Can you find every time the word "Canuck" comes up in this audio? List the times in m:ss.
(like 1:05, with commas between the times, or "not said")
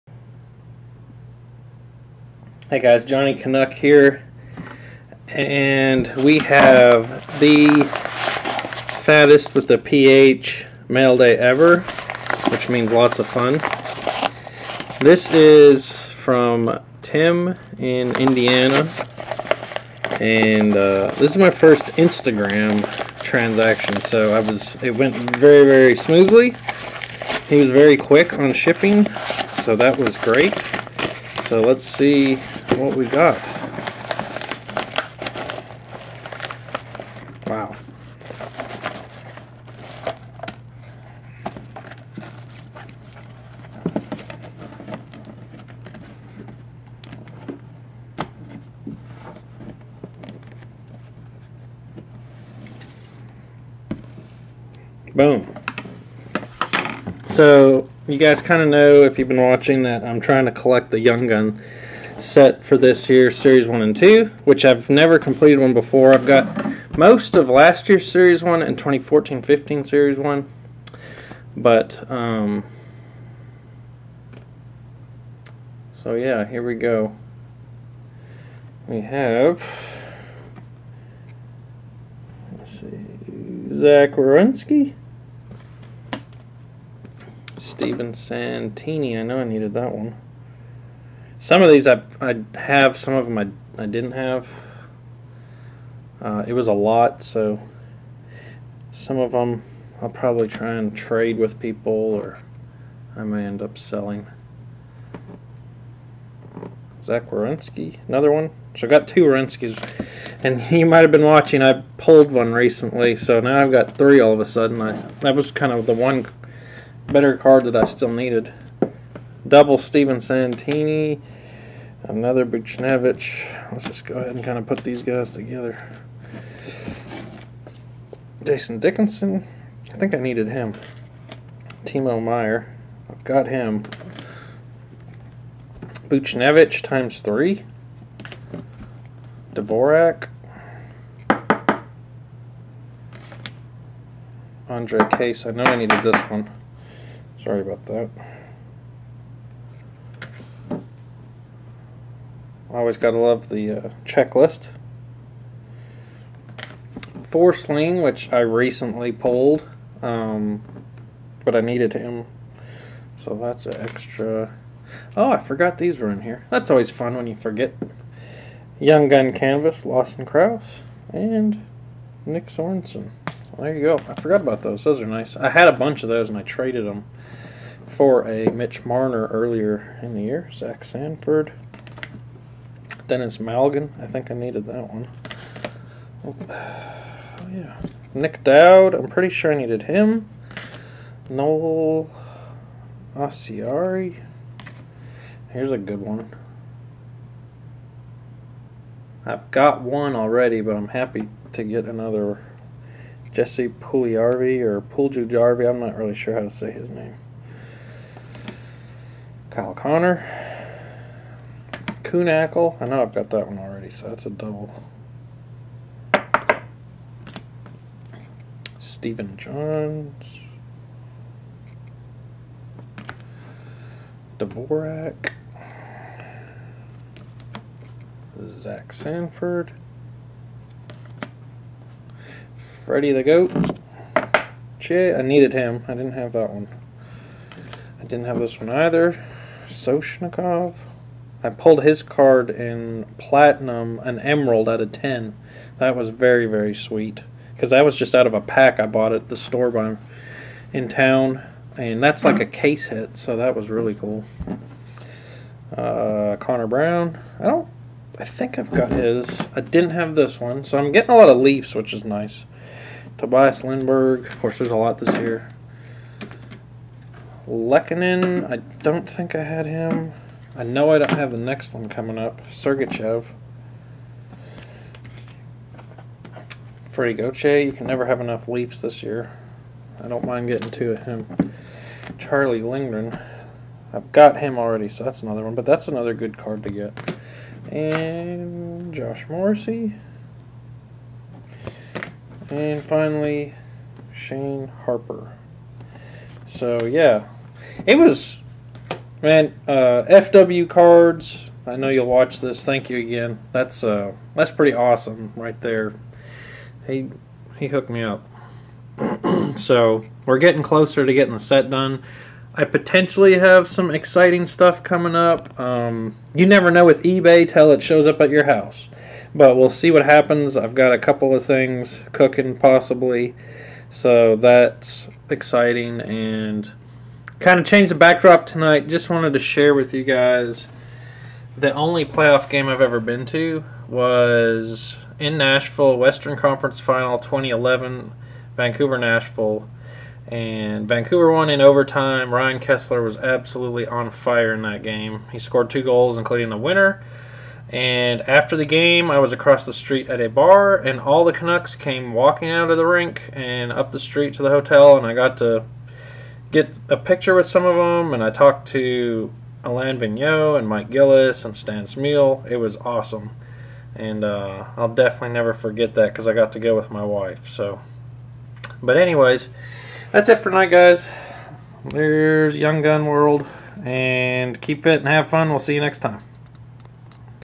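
0:03, 5:51.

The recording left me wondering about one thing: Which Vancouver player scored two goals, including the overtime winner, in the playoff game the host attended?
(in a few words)
Ryan Kesler.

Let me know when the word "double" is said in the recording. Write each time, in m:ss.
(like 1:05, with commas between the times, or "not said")
1:59, 3:34.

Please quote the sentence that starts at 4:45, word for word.
But that's another good card to get.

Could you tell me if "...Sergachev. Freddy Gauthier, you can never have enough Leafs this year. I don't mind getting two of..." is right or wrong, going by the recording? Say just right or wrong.
right.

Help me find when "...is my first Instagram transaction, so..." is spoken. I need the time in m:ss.
0:21.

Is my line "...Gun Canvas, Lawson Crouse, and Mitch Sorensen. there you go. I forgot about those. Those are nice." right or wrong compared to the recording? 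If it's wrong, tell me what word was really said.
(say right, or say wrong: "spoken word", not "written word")
wrong: "Nick", not "Mitch".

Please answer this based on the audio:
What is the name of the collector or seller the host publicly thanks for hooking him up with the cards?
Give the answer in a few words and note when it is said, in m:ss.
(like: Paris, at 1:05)
FW cards, at 5:00.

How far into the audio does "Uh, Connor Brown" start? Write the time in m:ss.
4:15.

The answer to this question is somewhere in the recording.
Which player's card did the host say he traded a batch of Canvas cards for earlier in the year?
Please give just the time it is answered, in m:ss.
2:58.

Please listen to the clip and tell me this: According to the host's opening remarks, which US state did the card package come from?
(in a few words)
Indiana.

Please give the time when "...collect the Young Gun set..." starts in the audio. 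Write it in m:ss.
1:00.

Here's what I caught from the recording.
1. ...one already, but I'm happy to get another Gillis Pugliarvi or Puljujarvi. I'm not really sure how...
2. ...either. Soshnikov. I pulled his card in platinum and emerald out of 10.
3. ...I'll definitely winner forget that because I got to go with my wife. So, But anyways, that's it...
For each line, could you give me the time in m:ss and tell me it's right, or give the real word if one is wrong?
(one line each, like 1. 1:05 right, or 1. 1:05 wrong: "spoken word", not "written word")
1. 3:19 wrong: "Jesse", not "Gillis"
2. 3:58 right
3. 6:04 wrong: "never", not "winner".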